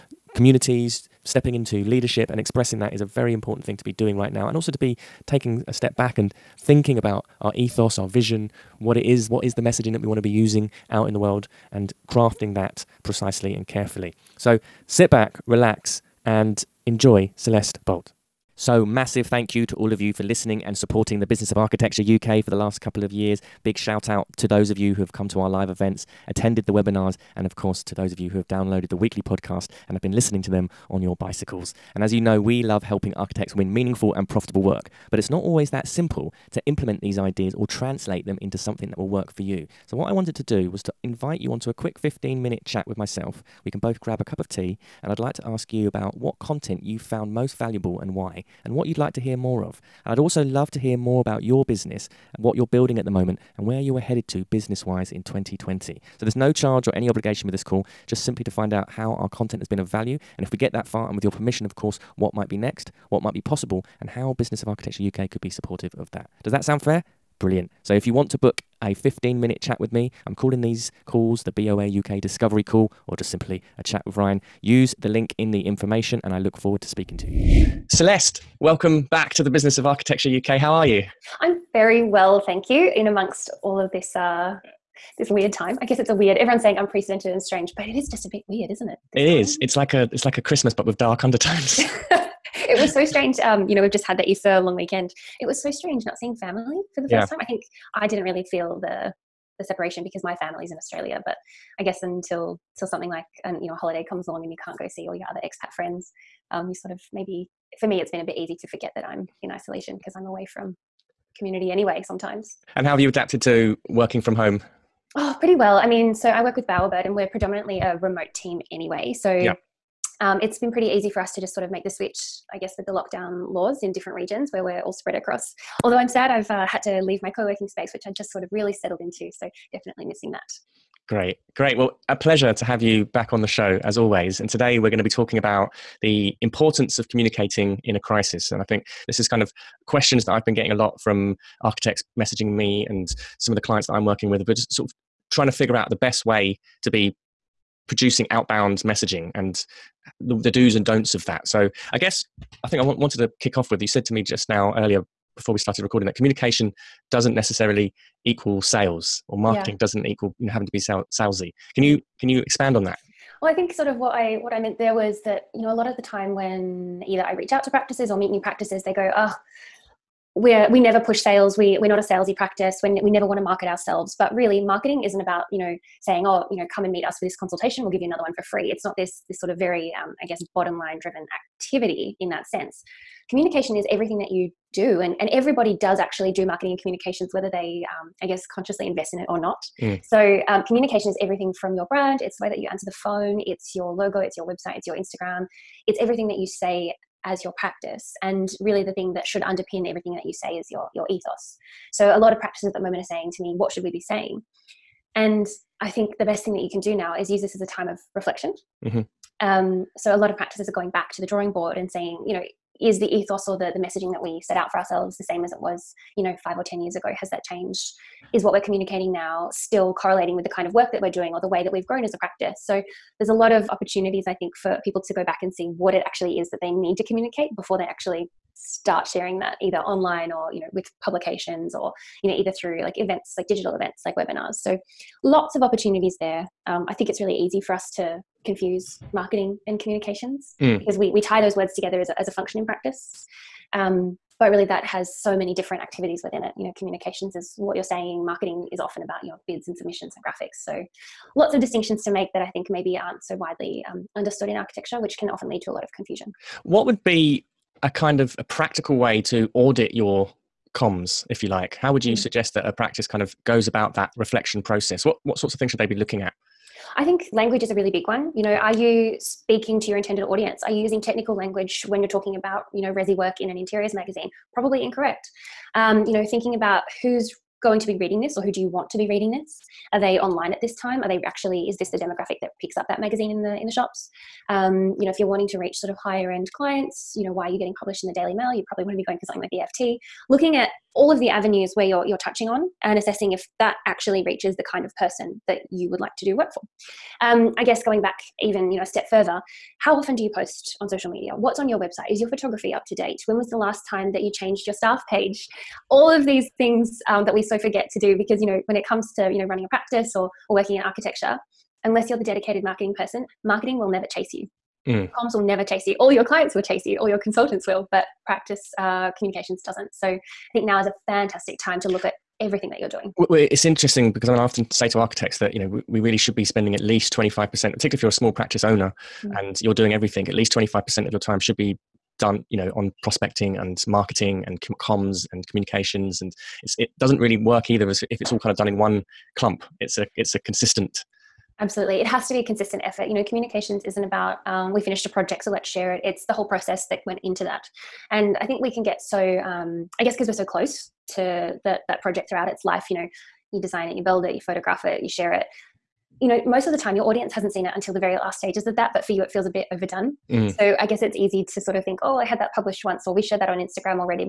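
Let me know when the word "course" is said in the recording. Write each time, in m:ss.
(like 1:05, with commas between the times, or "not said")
0:27, 1:01.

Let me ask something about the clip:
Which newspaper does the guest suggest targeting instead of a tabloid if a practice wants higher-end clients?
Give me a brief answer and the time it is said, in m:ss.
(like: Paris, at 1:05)
FT, at 4:49.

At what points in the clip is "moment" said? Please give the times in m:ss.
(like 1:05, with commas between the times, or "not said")
0:53, 3:22.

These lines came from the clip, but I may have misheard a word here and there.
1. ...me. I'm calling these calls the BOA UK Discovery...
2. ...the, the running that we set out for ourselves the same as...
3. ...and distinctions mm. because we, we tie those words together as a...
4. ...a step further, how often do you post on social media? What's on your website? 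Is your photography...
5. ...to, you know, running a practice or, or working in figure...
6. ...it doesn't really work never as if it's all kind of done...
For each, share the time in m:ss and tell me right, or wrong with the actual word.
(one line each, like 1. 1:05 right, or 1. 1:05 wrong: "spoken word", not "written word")
1. 1:09 right
2. 3:33 wrong: "messaging", not "running"
3. 3:59 wrong: "communications", not "distinctions"
4. 4:58 right
5. 5:09 wrong: "architecture", not "figure"
6. 5:36 wrong: "either", not "never".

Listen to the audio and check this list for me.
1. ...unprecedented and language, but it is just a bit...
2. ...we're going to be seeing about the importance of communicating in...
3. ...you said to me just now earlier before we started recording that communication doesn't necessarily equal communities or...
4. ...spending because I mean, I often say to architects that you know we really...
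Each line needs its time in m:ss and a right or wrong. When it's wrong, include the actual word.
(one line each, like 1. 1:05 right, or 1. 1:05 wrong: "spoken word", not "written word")
1. 1:26 wrong: "strange", not "language"
2. 2:14 wrong: "talking", not "seeing"
3. 2:33 wrong: "sales", not "communities"
4. 5:23 wrong: "interesting", not "spending".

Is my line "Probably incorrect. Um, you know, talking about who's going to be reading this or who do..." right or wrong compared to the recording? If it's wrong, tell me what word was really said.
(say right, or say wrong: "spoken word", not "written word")
wrong: "thinking", not "talking".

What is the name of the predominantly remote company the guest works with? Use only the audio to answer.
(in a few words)
Bowerbird.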